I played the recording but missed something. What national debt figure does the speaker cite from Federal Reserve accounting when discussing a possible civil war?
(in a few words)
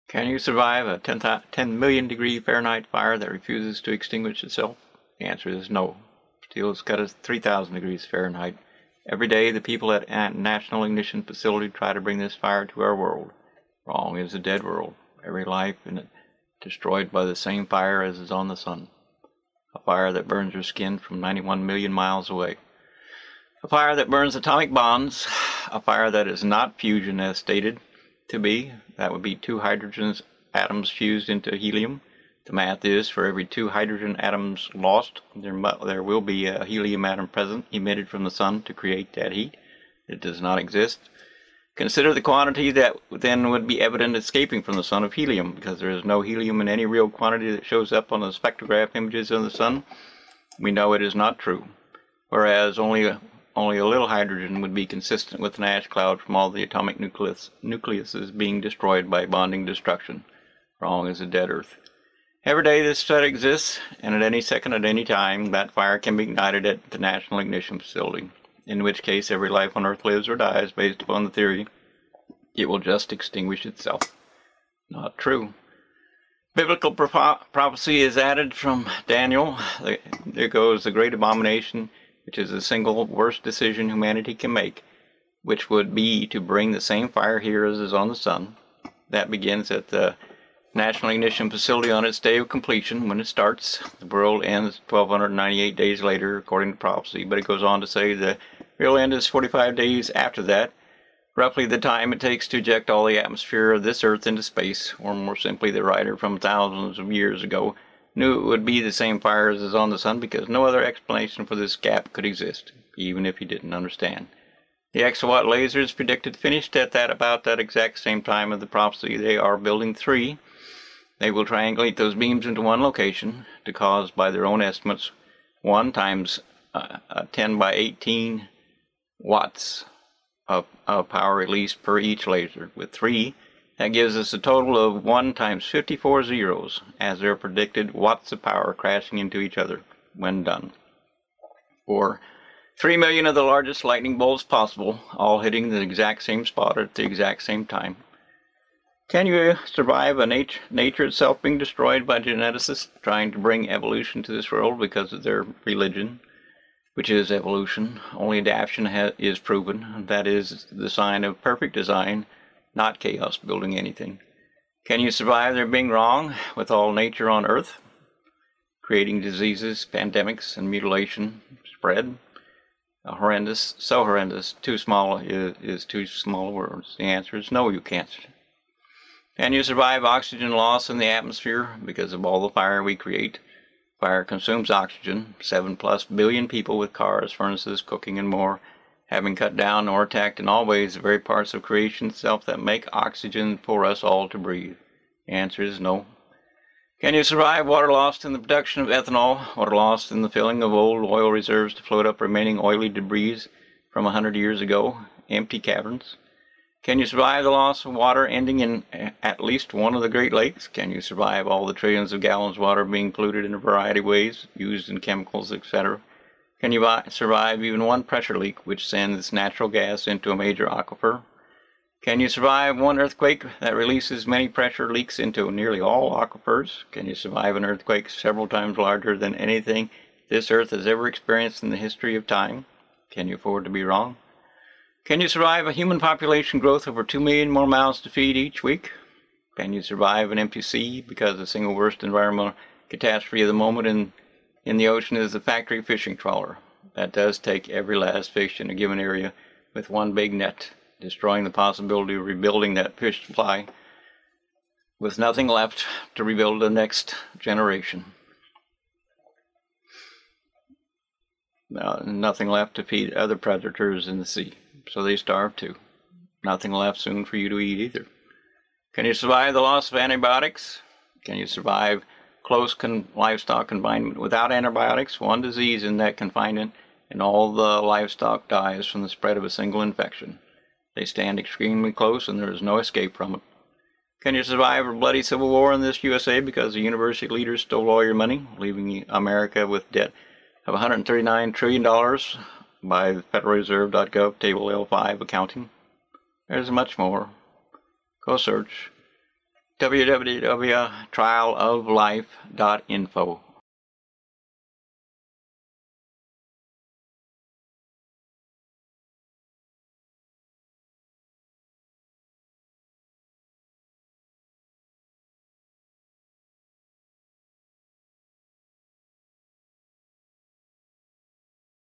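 $139 trillion.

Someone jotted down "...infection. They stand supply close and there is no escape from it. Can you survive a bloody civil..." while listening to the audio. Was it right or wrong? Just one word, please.
wrong.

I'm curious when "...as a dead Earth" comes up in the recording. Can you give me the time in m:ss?
1:01.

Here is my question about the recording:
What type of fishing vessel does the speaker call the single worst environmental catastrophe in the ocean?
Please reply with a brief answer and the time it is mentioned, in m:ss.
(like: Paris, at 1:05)
factory fishing trawler, at 4:05.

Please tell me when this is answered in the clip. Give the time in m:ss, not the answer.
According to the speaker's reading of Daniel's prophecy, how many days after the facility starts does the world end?
1:34.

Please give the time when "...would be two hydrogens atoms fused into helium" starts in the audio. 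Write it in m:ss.
0:29.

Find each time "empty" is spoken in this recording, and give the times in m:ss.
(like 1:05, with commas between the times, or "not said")
3:25, 4:00.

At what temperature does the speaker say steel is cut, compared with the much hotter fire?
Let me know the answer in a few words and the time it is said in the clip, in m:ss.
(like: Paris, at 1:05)
3,000 degrees Fahrenheit, at 0:07.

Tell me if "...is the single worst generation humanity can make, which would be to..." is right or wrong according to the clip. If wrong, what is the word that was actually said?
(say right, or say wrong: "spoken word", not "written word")
wrong: "decision", not "generation".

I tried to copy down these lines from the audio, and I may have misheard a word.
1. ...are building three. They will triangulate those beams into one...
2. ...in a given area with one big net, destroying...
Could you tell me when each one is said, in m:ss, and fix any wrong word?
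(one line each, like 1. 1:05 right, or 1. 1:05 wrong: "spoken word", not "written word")
1. 1:59 right
2. 4:08 right.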